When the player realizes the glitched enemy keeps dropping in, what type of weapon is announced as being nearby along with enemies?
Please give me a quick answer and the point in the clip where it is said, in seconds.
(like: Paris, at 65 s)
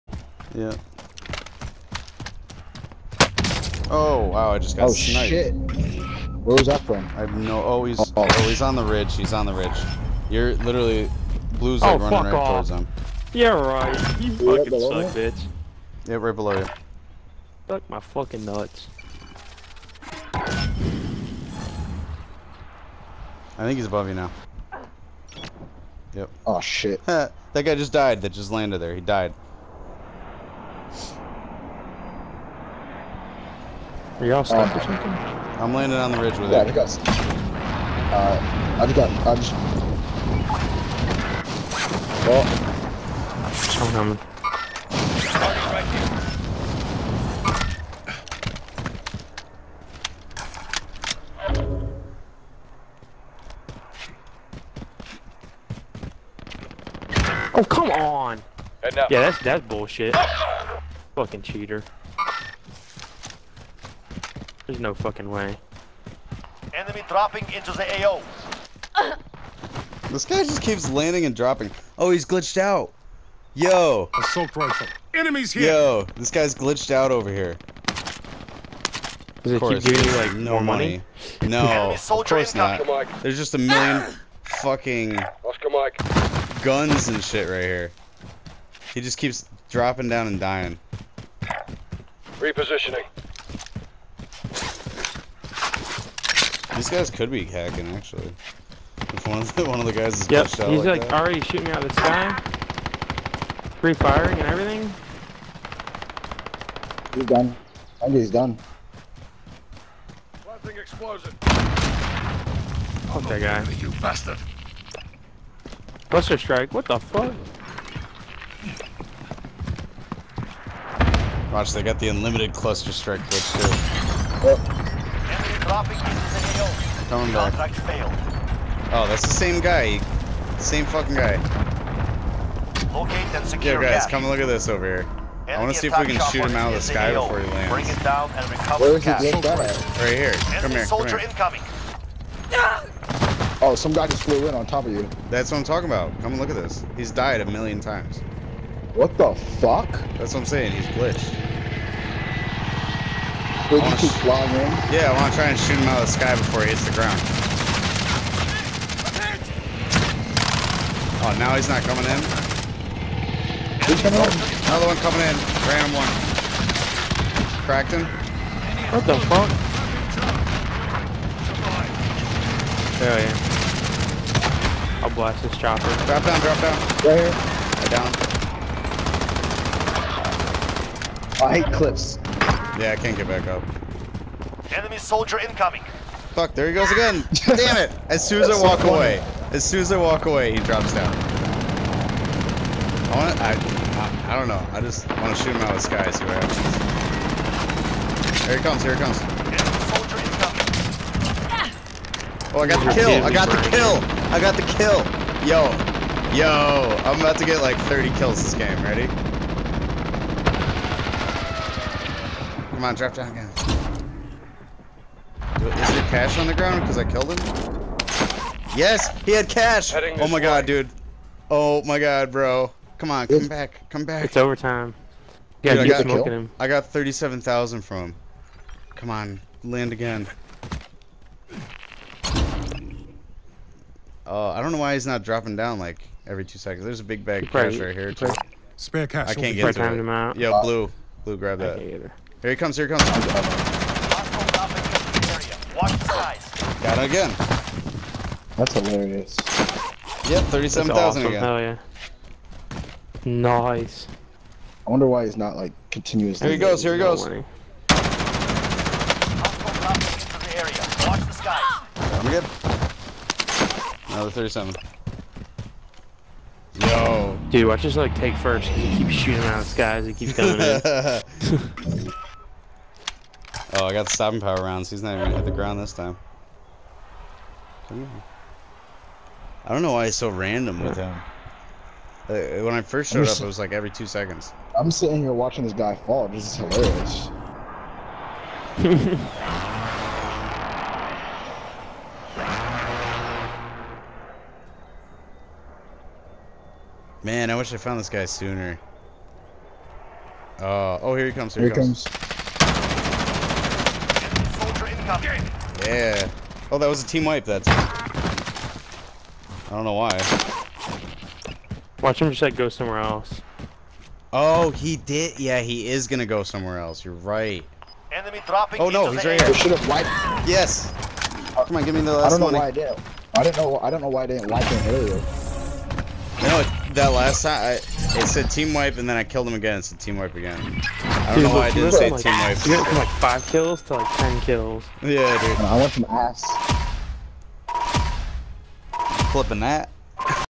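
Assault rifle, at 74 s.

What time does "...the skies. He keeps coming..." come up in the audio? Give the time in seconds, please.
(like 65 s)
269 s.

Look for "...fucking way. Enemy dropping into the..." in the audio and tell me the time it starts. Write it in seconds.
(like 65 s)
64 s.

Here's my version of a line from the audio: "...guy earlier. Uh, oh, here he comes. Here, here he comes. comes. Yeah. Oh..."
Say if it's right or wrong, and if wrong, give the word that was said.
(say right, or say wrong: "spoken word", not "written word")
wrong: "sooner", not "earlier".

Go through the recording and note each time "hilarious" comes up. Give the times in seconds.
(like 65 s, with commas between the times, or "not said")
248 s, 286 s.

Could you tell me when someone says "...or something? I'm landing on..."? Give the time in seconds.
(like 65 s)
34 s.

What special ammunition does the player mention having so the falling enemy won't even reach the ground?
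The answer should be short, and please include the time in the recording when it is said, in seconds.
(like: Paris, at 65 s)
Stopping power rounds, at 274 s.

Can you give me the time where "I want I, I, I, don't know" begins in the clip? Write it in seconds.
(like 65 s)
193 s.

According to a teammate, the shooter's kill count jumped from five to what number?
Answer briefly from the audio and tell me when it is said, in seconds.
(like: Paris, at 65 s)
10, at 334 s.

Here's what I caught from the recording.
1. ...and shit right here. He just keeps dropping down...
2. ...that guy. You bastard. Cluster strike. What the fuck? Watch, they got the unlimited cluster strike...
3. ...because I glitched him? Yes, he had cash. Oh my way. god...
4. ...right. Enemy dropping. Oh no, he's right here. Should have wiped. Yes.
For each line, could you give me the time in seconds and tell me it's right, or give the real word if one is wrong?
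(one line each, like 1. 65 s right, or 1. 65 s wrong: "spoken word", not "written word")
1. 87 s right
2. 113 s right
3. 216 s wrong: "killed", not "glitched"
4. 317 s right.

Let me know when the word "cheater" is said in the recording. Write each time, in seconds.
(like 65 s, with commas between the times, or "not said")
61 s.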